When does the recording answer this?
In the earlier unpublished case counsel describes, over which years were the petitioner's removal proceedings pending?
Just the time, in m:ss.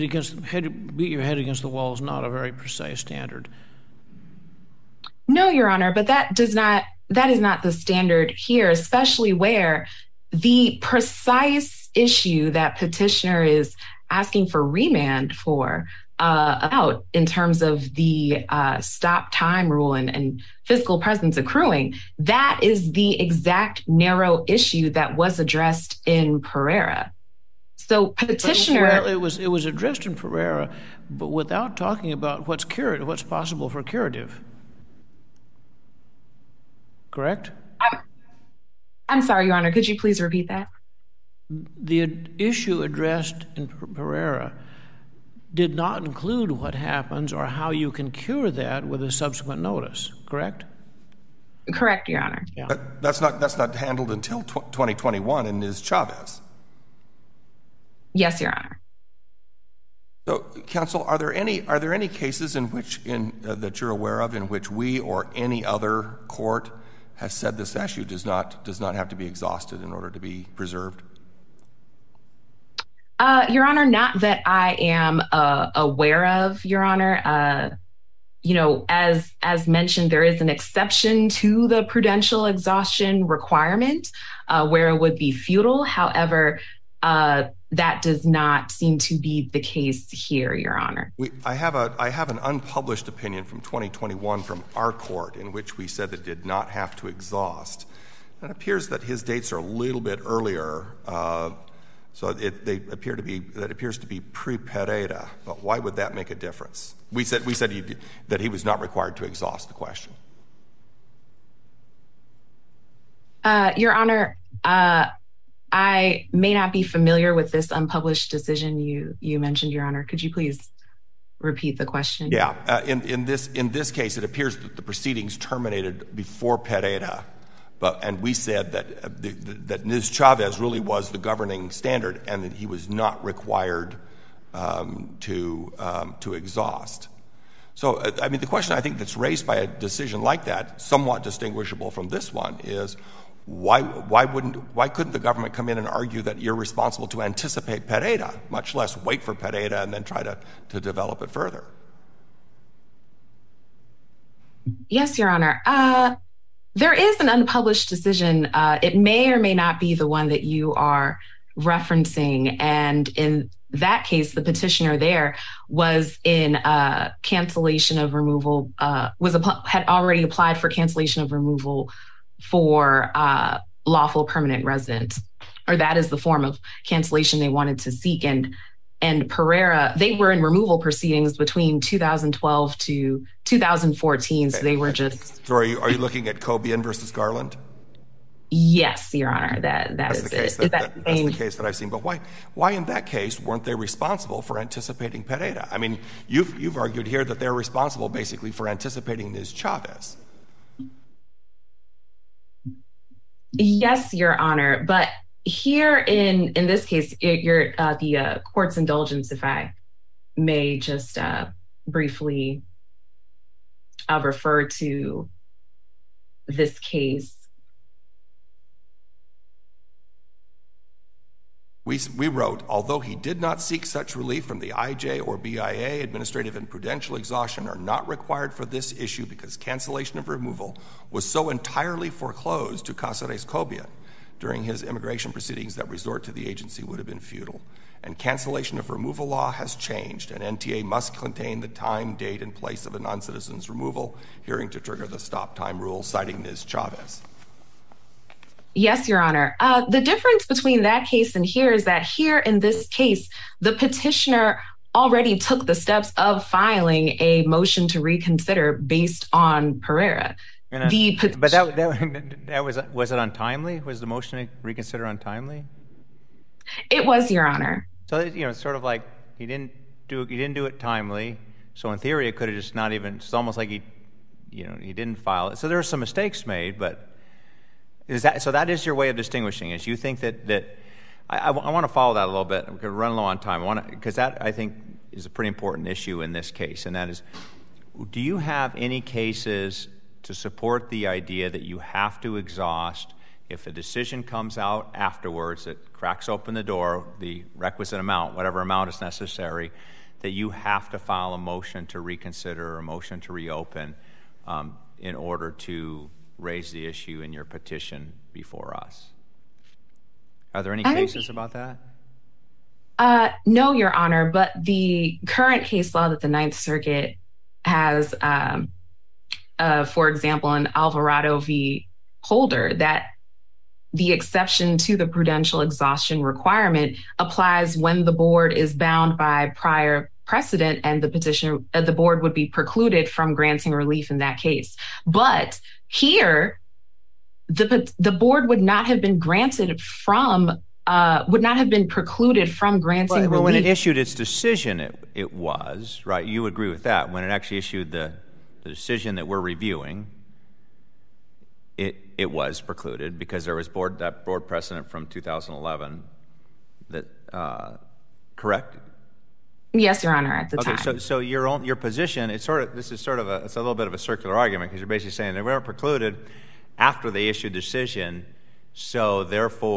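3:01.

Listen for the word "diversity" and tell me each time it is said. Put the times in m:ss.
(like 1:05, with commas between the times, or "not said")
not said.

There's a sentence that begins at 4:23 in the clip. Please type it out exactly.
Was the motion to reconsider untimely?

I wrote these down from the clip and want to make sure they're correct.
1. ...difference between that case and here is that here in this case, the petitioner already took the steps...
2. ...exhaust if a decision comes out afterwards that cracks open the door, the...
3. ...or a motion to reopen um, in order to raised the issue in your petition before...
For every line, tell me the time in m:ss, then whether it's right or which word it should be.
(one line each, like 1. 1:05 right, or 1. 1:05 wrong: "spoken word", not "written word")
1. 4:10 right
2. 4:52 right
3. 5:02 right.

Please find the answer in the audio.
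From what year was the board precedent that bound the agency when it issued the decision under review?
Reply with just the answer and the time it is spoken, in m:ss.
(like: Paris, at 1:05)
2011, at 5:55.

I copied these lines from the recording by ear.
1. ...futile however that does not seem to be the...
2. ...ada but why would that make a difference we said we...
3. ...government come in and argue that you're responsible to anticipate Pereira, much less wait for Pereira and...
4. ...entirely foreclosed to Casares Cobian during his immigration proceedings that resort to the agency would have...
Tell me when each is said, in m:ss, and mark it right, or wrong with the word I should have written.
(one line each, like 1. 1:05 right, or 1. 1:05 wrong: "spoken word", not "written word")
1. 1:25 right
2. 1:44 right
3. 2:25 right
4. 3:51 right.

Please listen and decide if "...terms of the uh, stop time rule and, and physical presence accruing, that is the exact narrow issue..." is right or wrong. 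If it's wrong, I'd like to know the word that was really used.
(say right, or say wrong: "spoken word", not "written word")
right.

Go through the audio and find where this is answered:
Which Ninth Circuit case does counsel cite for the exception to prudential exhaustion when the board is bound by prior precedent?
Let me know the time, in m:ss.
5:20.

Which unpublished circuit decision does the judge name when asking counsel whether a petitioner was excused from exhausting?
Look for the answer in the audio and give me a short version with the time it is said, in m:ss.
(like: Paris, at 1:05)
Cobian versus Garland, at 3:06.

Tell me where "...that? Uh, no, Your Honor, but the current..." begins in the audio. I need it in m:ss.
5:11.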